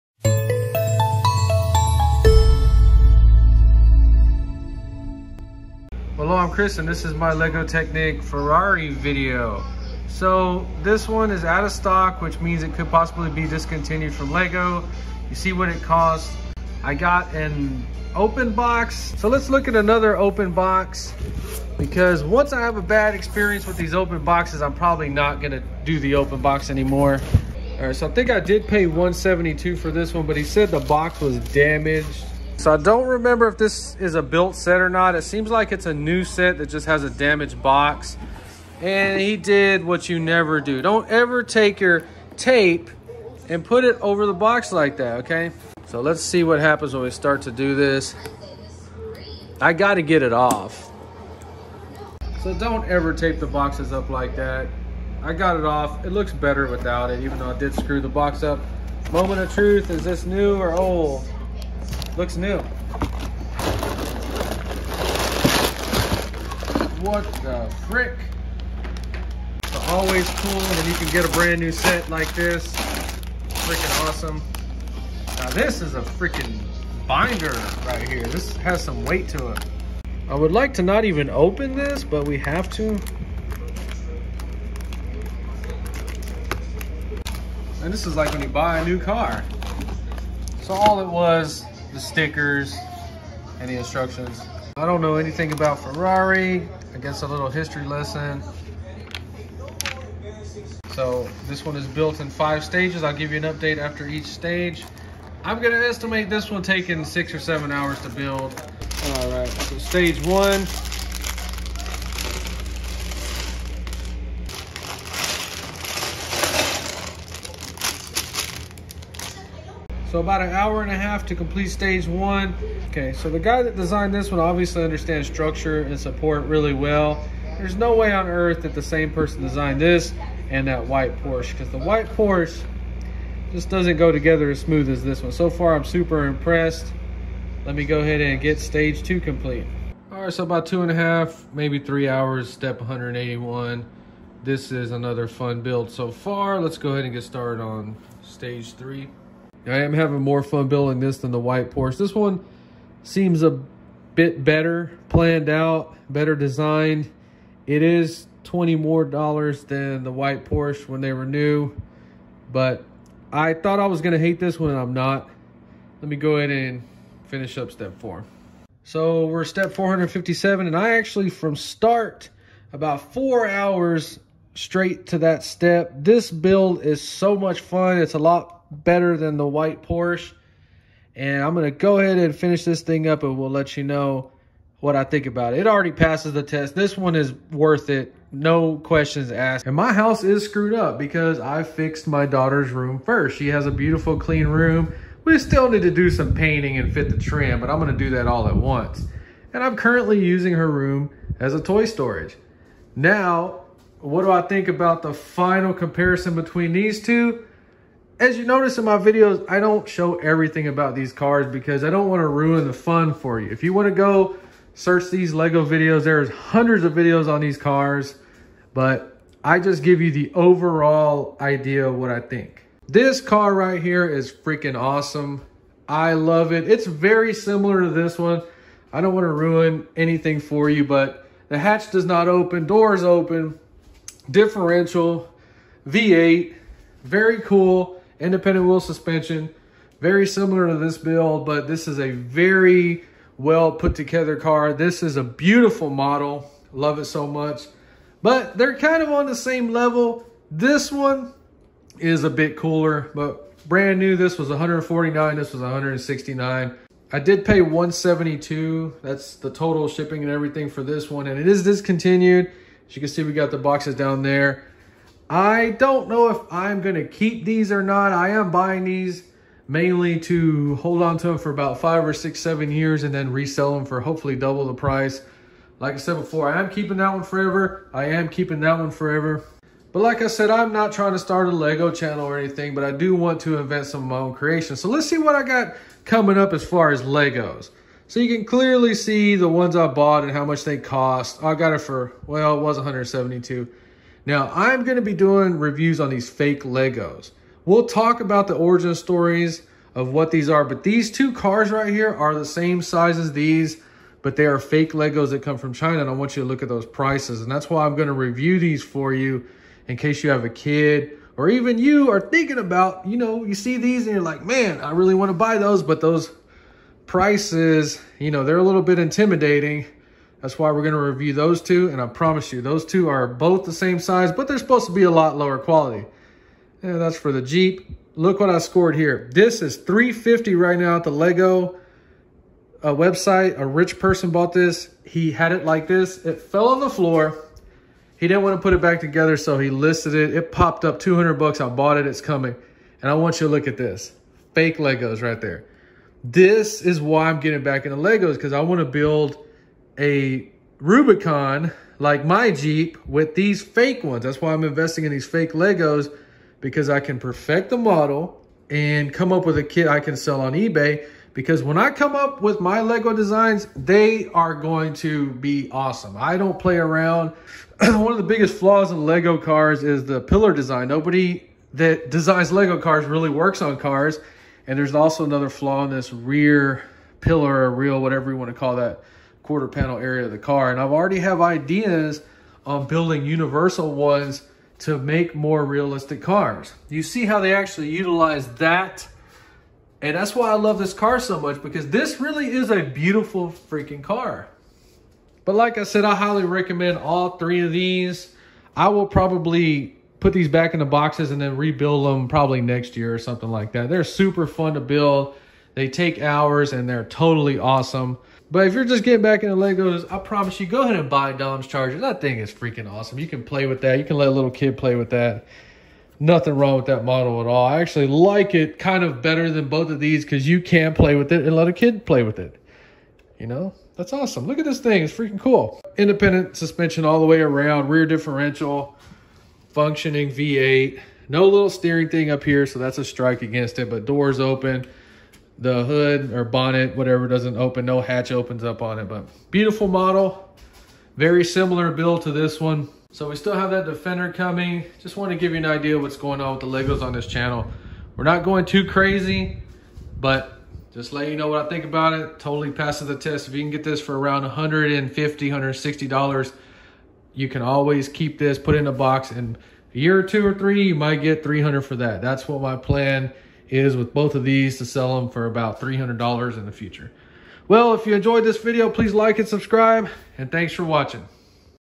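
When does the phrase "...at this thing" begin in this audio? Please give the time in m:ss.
7:04.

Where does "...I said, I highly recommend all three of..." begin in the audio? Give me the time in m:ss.
6:35.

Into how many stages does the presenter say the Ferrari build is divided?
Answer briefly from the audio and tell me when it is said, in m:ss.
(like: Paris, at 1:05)
5, at 1:42.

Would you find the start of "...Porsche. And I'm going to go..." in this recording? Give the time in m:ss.
2:59.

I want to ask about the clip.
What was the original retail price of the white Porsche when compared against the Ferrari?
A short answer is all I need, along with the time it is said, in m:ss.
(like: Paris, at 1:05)
$149, at 4:14.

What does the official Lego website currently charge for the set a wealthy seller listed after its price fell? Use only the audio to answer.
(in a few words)
$350.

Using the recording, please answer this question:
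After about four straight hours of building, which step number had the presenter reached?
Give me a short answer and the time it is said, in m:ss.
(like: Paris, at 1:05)
457, at 2:49.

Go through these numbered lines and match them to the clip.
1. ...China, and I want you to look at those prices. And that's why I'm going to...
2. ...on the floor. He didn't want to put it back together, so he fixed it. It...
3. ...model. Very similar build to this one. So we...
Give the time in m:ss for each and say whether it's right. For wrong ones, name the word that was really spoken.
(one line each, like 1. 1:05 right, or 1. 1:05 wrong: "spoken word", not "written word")
1. 5:05 right
2. 5:36 wrong: "listed", not "fixed"
3. 7:19 right.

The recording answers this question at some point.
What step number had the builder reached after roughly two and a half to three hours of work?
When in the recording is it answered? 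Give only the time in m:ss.
2:22.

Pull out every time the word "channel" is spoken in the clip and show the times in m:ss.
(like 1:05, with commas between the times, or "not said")
4:41, 7:27.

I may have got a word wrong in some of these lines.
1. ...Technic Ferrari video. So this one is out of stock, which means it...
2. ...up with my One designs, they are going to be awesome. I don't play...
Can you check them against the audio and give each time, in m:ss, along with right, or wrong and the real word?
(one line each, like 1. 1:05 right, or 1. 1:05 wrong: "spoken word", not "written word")
1. 0:07 right
2. 6:02 wrong: "Lego", not "One".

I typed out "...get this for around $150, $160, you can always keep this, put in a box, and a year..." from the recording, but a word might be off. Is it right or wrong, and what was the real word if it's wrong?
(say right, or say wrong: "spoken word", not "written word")
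right.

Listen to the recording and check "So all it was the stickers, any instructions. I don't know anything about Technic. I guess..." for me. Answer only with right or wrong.
wrong.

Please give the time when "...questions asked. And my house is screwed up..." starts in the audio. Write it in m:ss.
3:08.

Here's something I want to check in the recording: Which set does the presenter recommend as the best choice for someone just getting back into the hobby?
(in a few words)
Dom's Charger.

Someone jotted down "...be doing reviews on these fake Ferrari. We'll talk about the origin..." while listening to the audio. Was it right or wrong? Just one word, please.
wrong.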